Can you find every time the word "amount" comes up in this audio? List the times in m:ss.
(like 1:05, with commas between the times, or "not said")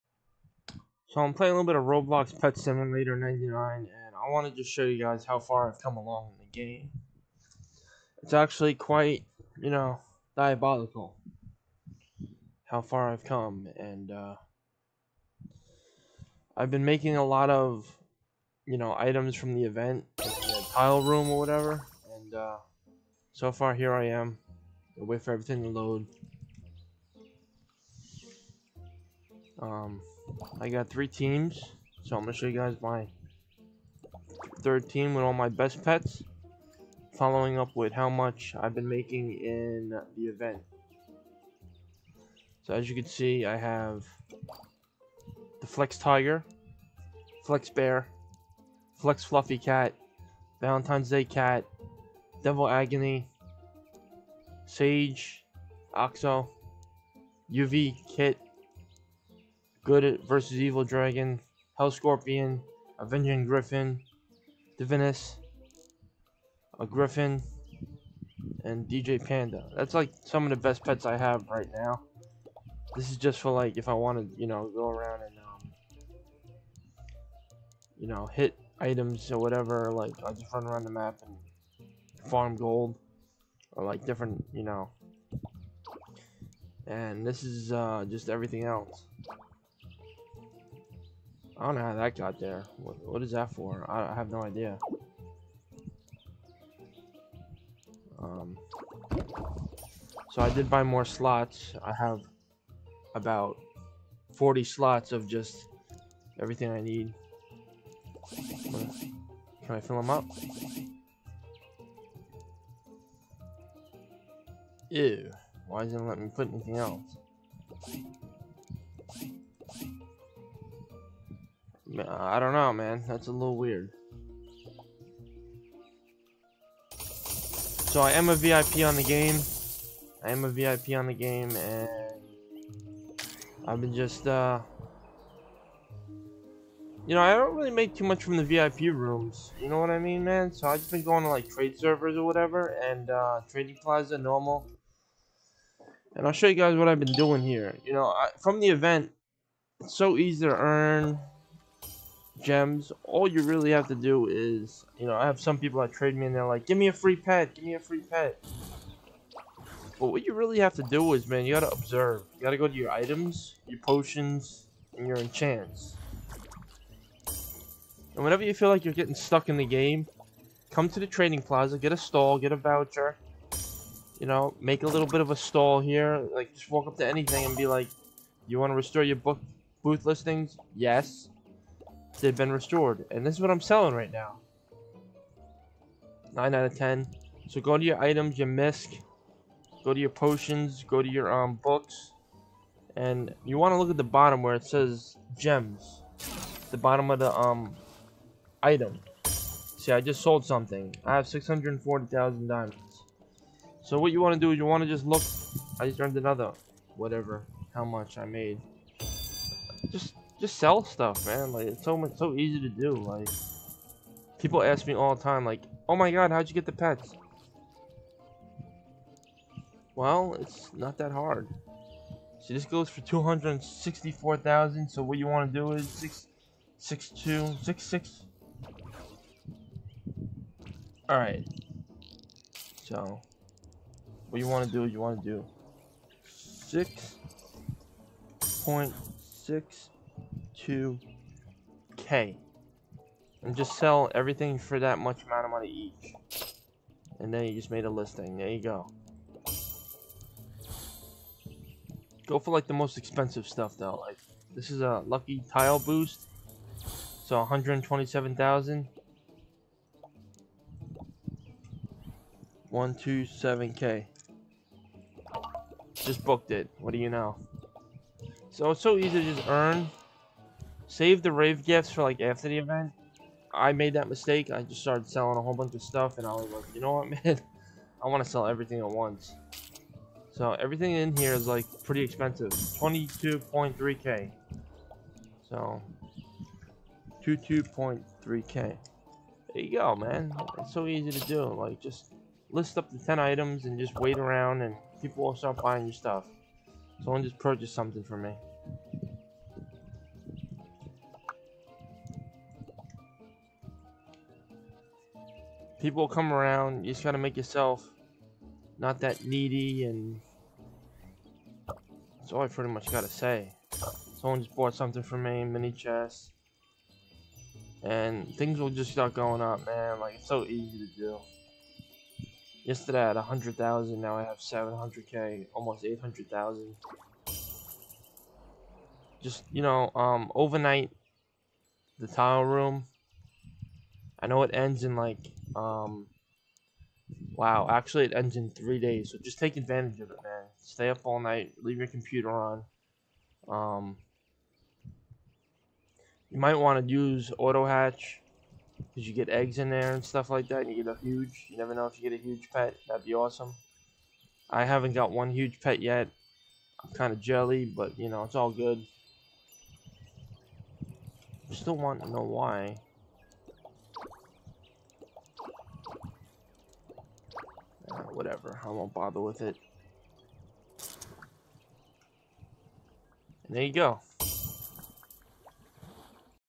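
4:05.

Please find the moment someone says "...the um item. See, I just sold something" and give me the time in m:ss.
3:17.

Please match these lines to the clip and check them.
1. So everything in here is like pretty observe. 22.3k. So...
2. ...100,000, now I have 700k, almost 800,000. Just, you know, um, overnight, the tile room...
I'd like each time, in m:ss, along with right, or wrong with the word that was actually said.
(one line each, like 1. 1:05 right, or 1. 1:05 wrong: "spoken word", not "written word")
1. 4:40 wrong: "expensive", not "observe"
2. 5:23 right.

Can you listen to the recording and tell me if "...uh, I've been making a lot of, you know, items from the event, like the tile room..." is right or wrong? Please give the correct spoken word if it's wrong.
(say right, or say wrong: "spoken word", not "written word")
right.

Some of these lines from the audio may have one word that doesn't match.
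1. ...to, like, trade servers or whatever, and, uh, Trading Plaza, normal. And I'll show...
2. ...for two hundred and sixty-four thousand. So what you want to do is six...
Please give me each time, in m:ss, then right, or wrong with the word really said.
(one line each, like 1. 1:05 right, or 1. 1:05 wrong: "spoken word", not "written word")
1. 2:21 right
2. 3:42 right.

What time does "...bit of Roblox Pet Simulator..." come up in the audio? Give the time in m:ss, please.
0:01.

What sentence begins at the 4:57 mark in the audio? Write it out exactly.
Someone just purchased something for me.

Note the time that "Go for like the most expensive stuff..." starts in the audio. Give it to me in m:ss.
4:12.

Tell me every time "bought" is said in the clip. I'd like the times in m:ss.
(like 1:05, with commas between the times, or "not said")
5:14.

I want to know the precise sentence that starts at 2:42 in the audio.
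You gotta go to your items, your potions, and your enchants.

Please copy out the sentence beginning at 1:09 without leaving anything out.
That's like some of the best pets I have right now.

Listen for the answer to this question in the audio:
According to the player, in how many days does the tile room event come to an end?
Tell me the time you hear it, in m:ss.
5:38.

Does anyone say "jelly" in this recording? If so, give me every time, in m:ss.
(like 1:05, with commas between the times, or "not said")
5:57.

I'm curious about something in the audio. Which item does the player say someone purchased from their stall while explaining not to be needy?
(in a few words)
mini chest.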